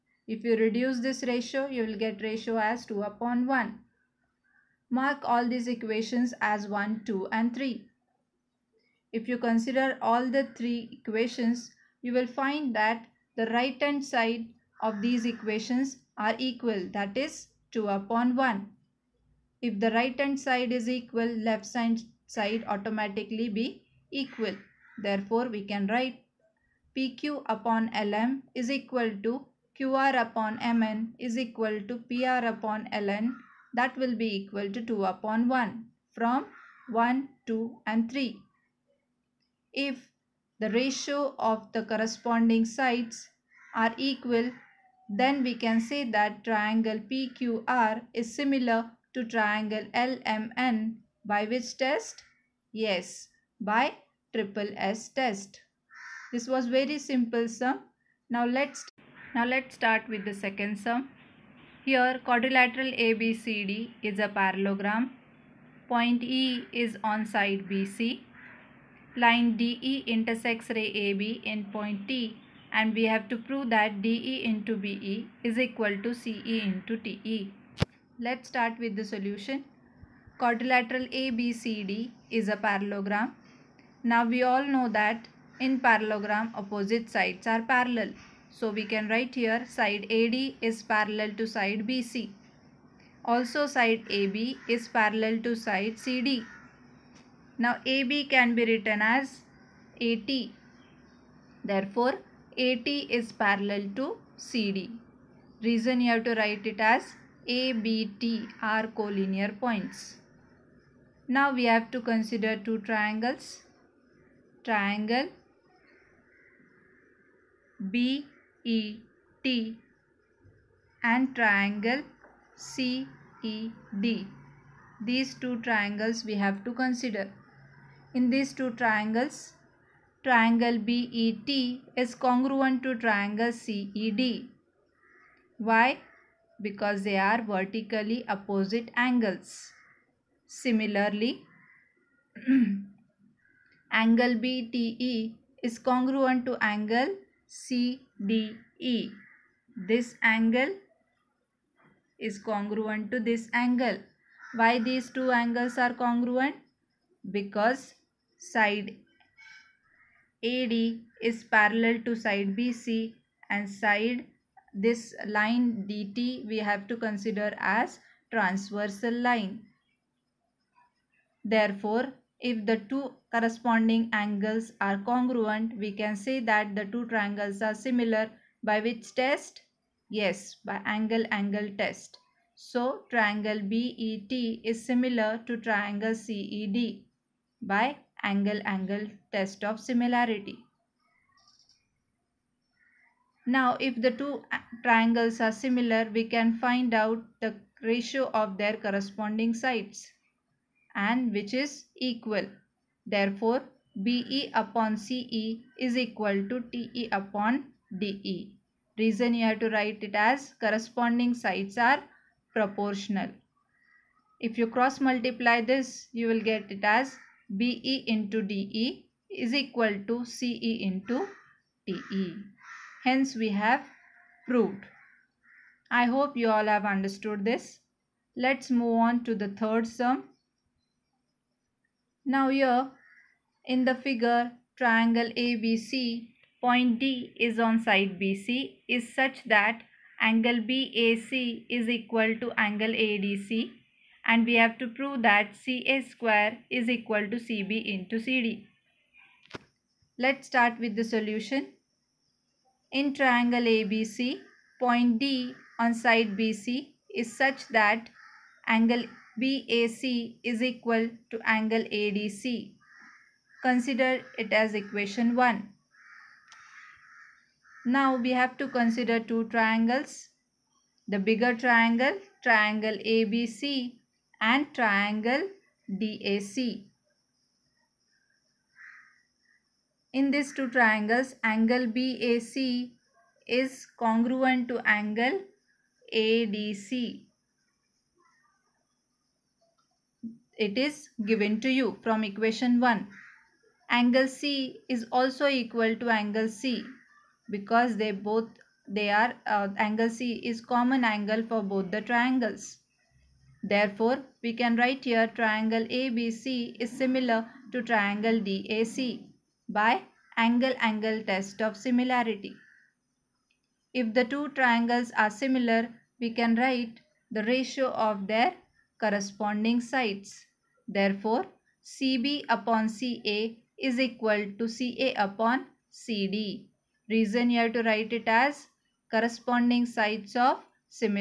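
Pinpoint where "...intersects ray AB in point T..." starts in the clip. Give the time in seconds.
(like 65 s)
70 s.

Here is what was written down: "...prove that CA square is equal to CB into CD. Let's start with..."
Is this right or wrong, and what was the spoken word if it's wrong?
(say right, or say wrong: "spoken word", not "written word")
right.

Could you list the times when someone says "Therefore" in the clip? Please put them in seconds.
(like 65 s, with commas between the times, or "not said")
25 s, 101 s, 171 s, 203 s, 303 s, 320 s.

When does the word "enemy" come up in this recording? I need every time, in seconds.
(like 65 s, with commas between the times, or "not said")
not said.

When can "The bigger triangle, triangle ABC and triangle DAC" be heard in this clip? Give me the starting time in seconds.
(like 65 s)
271 s.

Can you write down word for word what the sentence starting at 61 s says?
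Here quadrilateral ABCD is a parallelogram.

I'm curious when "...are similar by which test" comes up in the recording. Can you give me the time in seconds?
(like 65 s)
177 s.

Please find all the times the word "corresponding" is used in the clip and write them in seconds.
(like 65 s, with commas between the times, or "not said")
41 s, 173 s, 198 s, 210 s, 318 s, 329 s.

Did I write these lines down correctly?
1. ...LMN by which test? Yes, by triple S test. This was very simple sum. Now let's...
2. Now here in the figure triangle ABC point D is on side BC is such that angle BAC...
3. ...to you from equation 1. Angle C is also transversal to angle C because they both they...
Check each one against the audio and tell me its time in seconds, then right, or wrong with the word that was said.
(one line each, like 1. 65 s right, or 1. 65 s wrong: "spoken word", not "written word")
1. 49 s right
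2. 232 s right
3. 291 s wrong: "equal", not "transversal".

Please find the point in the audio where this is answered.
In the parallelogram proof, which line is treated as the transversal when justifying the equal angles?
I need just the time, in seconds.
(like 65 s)
165 s.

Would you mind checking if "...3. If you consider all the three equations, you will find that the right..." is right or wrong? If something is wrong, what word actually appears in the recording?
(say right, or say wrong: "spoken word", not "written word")
right.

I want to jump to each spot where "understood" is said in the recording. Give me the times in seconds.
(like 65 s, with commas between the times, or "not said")
226 s.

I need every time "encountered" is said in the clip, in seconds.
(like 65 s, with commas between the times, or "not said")
not said.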